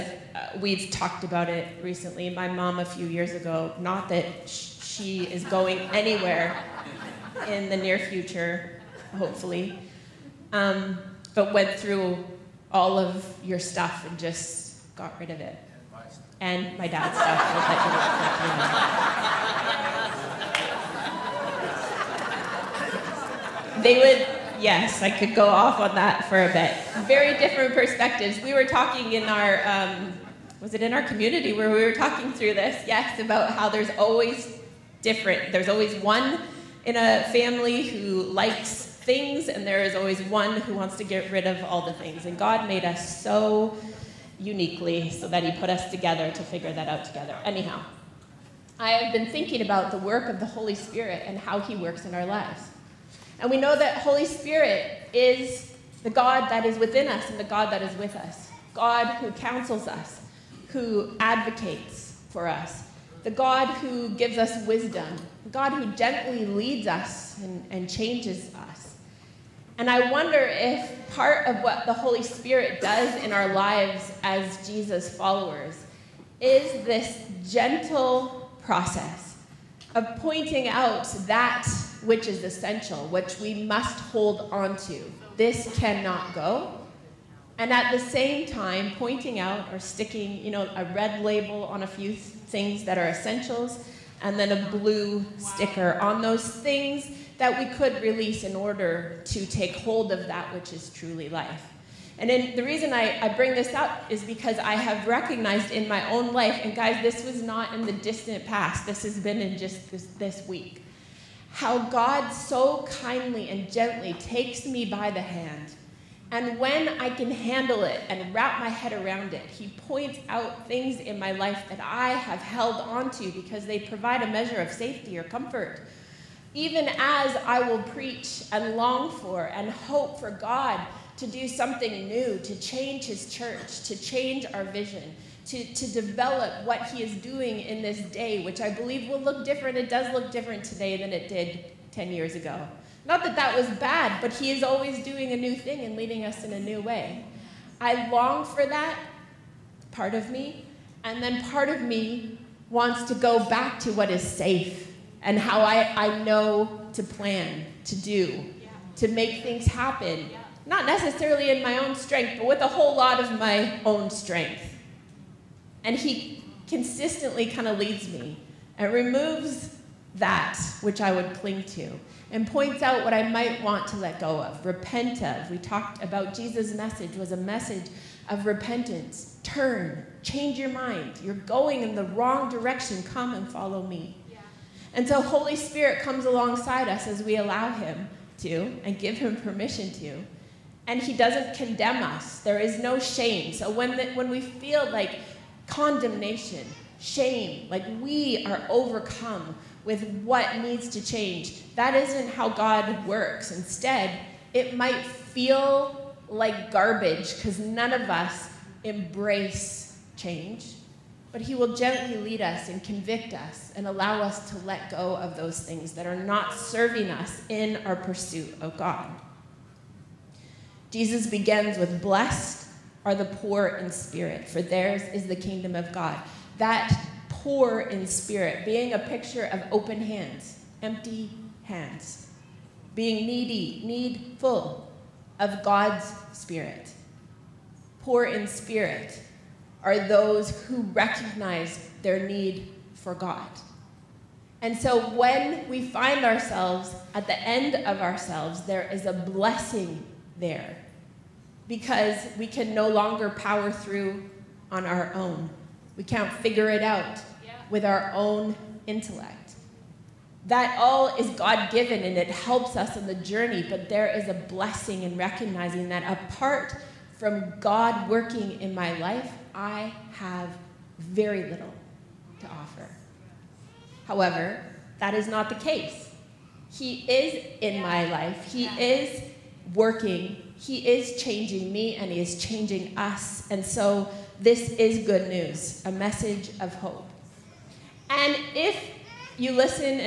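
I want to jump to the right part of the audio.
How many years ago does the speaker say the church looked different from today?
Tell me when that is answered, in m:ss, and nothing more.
2:21.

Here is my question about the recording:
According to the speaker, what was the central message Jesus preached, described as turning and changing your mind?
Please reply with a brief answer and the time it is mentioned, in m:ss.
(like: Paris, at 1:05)
Repentance, at 2:58.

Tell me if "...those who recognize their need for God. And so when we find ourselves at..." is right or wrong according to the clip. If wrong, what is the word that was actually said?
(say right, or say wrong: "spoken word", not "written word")
right.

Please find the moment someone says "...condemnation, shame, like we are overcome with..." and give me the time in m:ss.
3:15.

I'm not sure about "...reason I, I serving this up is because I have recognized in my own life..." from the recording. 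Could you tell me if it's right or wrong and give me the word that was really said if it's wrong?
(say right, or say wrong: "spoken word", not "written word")
wrong: "bring", not "serving".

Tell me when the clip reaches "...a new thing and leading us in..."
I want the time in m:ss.
2:25.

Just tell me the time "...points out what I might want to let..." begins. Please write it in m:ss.
2:52.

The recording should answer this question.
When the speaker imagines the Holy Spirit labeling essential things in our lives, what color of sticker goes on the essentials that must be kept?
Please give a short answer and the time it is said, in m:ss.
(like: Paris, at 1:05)
Red, at 1:30.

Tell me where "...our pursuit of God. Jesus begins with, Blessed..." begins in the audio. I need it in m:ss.
3:37.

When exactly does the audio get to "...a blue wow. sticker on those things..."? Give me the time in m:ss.
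1:34.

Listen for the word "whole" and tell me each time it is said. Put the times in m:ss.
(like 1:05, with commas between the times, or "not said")
2:42.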